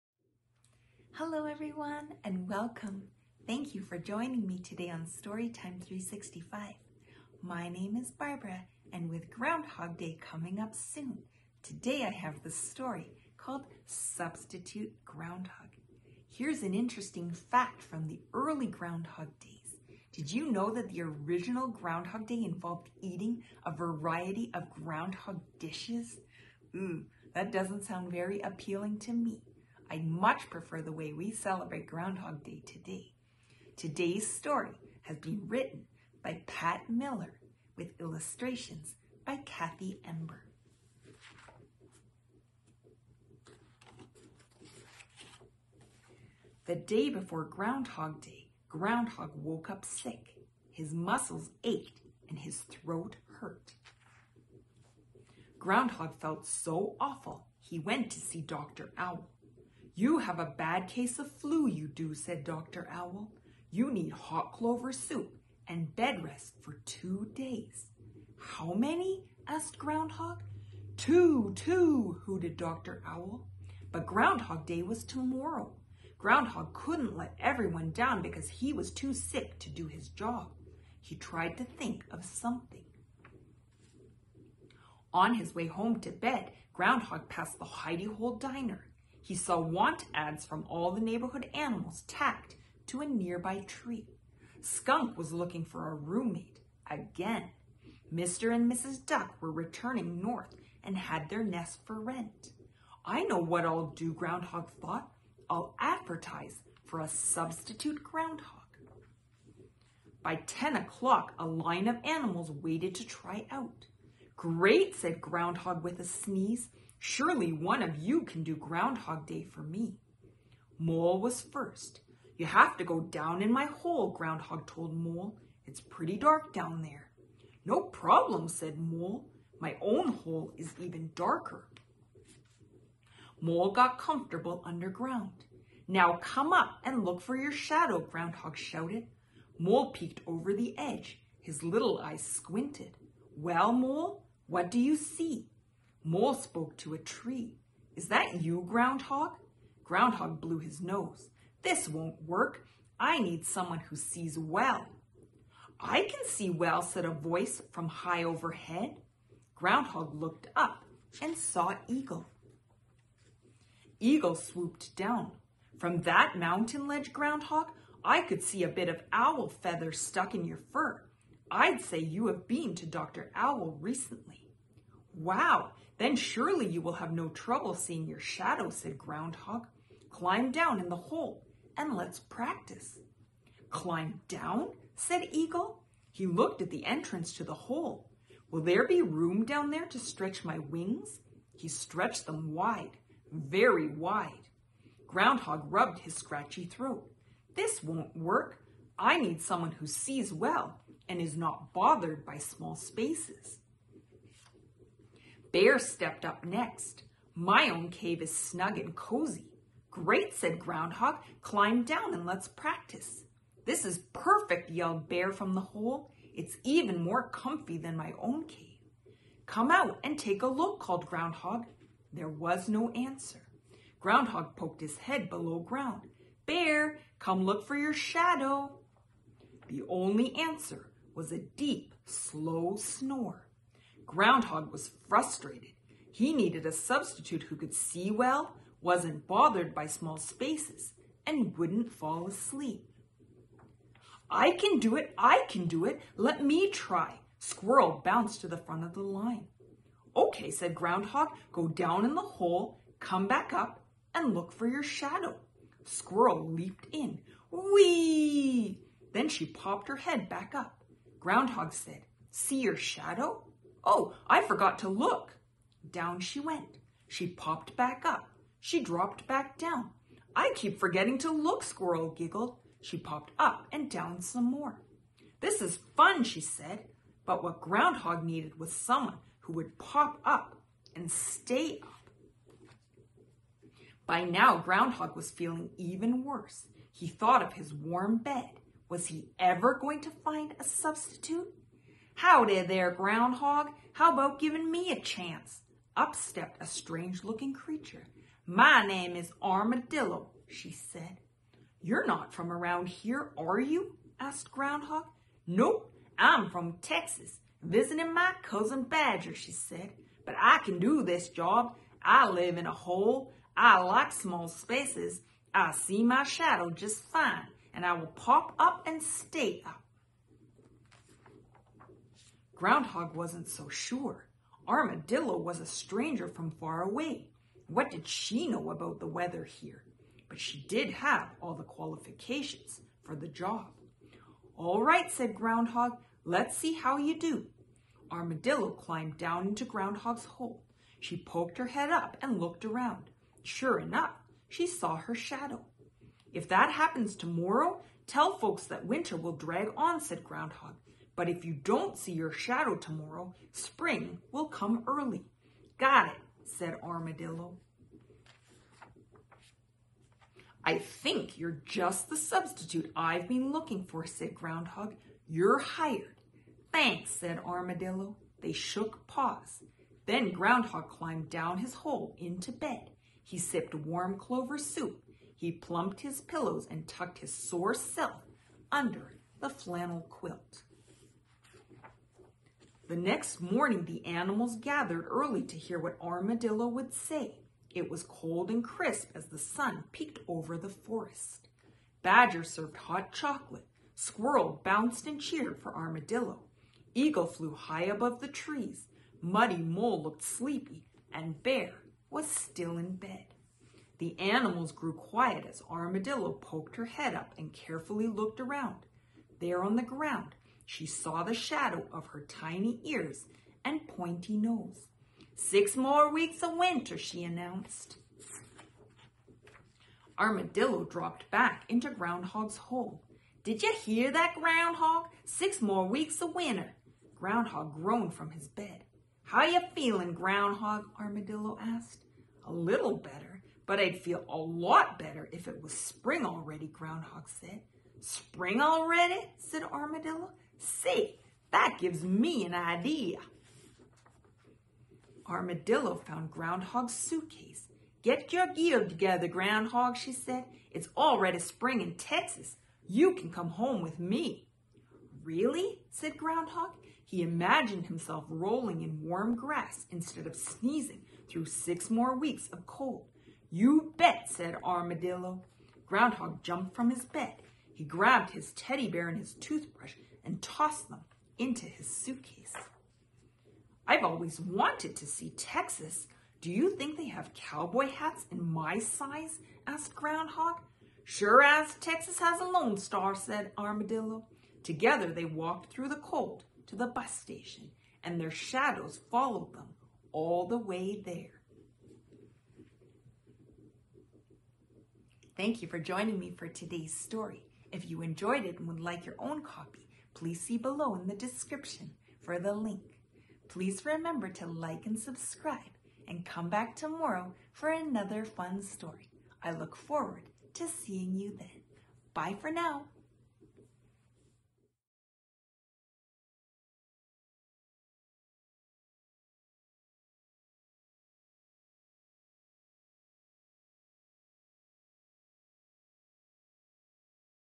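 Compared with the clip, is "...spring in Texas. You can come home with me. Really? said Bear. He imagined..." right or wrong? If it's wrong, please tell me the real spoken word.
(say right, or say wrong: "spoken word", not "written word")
wrong: "Groundhog", not "Bear".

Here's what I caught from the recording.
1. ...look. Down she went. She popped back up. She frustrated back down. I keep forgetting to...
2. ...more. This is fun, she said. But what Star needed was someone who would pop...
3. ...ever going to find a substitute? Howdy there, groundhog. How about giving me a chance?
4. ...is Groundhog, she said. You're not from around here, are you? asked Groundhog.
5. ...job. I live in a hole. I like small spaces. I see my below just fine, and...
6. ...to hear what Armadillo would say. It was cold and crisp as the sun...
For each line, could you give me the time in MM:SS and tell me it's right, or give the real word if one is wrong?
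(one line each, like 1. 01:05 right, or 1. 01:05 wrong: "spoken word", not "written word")
1. 04:24 wrong: "dropped", not "frustrated"
2. 04:34 wrong: "Groundhog", not "Star"
3. 04:49 right
4. 04:59 wrong: "Armadillo", not "Groundhog"
5. 05:11 wrong: "shadow", not "below"
6. 06:25 right.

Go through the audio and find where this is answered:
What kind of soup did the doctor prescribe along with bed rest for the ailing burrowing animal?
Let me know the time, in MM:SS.
01:04.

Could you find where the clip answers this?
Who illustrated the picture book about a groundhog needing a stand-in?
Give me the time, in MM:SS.
00:39.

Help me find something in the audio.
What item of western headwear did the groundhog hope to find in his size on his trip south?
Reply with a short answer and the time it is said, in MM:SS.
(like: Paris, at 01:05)
Cowboy hats, at 07:57.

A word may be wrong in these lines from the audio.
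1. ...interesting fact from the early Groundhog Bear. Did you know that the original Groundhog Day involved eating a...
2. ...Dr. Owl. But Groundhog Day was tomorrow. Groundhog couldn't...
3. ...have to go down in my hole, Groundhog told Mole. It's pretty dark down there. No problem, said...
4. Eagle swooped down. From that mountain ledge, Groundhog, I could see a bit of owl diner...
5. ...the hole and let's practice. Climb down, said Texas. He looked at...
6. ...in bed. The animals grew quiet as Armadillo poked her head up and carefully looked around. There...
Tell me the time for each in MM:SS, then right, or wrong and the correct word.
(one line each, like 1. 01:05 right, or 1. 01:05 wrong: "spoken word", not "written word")
1. 00:16 wrong: "Days", not "Bear"
2. 01:12 right
3. 02:02 right
4. 02:43 wrong: "feather", not "diner"
5. 03:00 wrong: "Eagle", not "Texas"
6. 06:42 right.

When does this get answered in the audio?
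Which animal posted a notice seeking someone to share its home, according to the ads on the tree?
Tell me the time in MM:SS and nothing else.
01:34.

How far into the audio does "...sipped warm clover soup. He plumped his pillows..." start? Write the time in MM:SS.
06:13.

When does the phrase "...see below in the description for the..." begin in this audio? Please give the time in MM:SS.
08:20.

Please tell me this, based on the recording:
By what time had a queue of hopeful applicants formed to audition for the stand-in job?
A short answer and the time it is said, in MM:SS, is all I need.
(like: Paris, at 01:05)
10 o'clock, at 01:50.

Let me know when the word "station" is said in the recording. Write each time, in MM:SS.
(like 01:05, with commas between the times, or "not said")
08:07.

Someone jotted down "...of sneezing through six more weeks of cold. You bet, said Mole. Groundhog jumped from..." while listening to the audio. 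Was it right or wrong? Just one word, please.
wrong.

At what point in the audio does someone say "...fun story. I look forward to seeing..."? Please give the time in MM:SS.
08:28.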